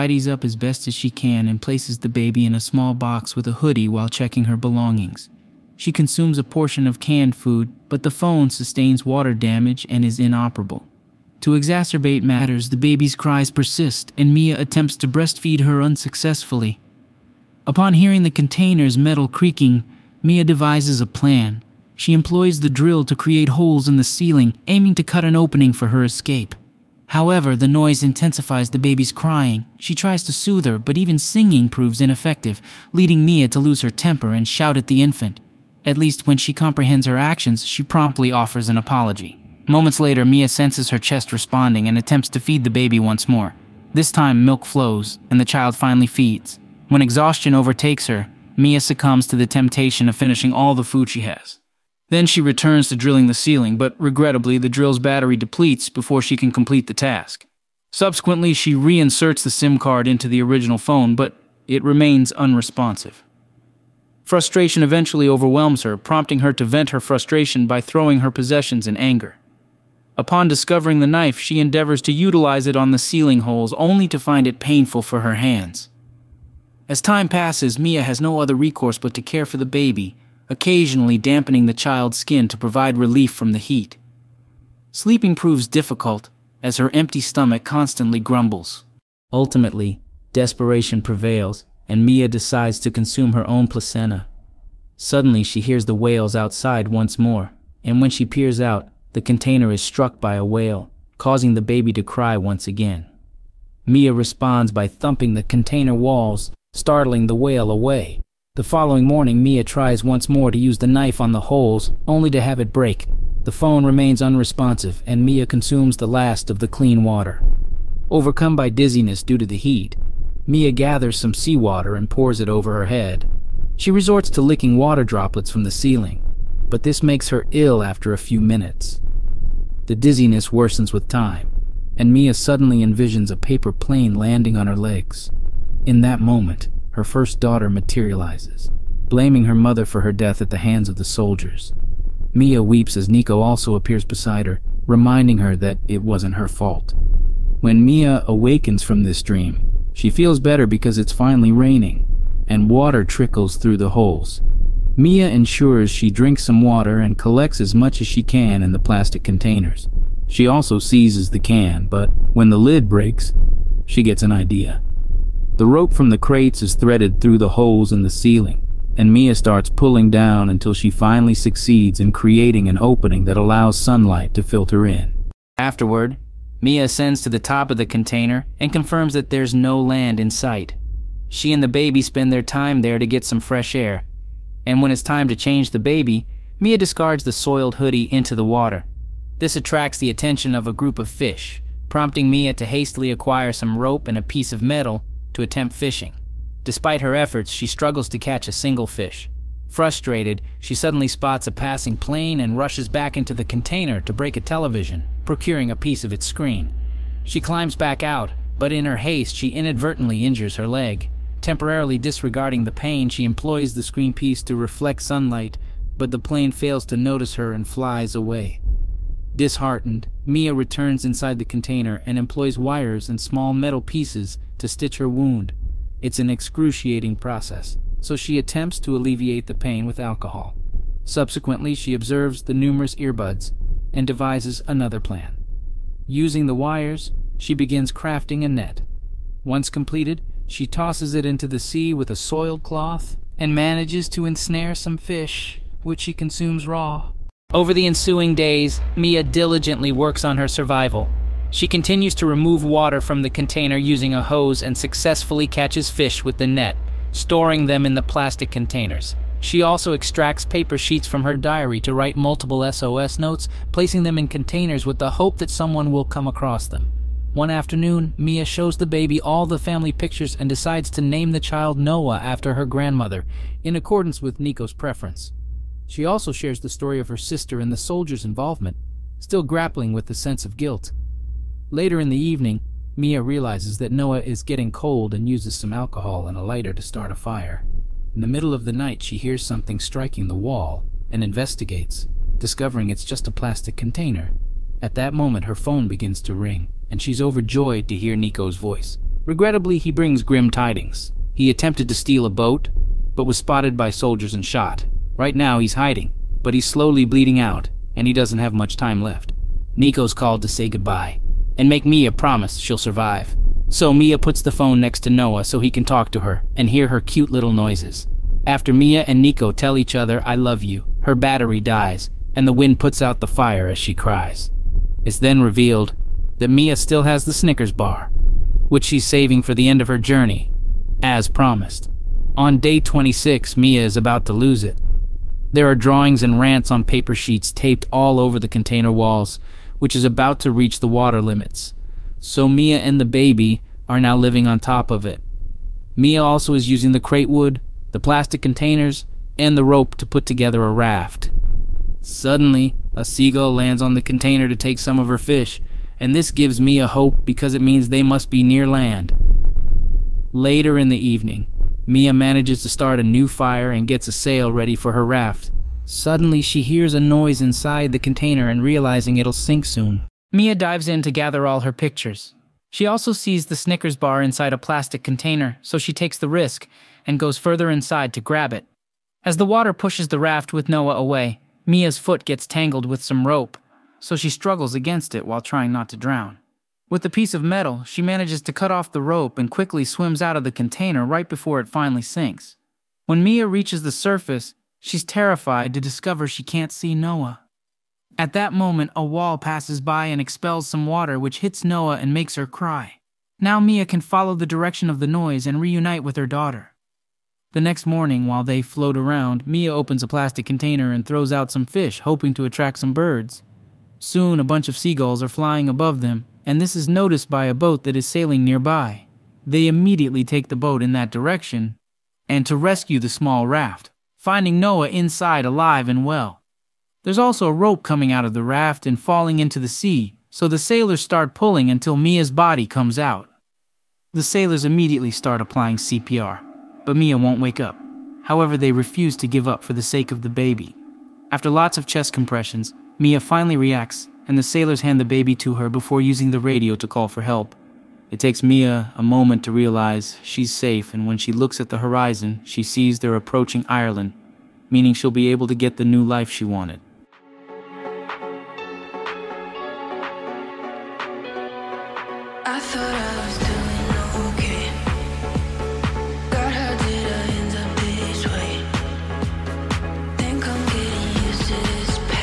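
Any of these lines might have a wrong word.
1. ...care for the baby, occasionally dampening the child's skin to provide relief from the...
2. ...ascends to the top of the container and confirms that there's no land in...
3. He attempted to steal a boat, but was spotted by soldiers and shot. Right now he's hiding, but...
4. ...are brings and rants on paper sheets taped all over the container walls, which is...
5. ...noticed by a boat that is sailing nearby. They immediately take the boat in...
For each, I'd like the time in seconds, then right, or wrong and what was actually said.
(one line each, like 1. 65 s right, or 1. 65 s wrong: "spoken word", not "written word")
1. 79 s right
2. 176 s right
3. 301 s right
4. 335 s wrong: "drawings", not "brings"
5. 416 s right.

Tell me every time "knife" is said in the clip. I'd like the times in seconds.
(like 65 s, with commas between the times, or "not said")
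71 s, 110 s.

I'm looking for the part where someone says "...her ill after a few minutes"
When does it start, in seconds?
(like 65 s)
127 s.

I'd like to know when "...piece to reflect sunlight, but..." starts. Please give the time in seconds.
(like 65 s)
214 s.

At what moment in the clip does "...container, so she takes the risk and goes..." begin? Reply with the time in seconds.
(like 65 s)
375 s.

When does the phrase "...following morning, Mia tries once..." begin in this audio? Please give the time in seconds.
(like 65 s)
108 s.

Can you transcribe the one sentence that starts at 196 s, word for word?
Despite her efforts, she struggles to catch a single fish.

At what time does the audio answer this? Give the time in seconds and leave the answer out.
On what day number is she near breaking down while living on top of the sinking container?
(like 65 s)
332 s.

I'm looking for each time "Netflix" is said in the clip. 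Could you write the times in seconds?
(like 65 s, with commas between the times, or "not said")
not said.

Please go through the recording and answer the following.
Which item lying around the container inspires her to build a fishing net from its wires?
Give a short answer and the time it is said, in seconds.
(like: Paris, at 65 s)
earbuds, at 232 s.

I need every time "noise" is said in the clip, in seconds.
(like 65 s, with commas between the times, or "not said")
27 s, 317 s, 366 s, 405 s.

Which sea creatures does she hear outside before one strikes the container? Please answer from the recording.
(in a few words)
whales.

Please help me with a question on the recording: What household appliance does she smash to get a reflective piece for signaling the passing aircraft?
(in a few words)
television.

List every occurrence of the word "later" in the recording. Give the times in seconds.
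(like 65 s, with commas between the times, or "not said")
39 s, 281 s, 360 s.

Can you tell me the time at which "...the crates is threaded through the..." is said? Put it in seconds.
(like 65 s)
166 s.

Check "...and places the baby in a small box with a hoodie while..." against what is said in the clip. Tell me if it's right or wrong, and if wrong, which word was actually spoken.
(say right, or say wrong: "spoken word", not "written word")
right.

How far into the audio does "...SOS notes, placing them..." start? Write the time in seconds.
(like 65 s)
262 s.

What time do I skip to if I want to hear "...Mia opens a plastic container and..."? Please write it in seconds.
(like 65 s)
409 s.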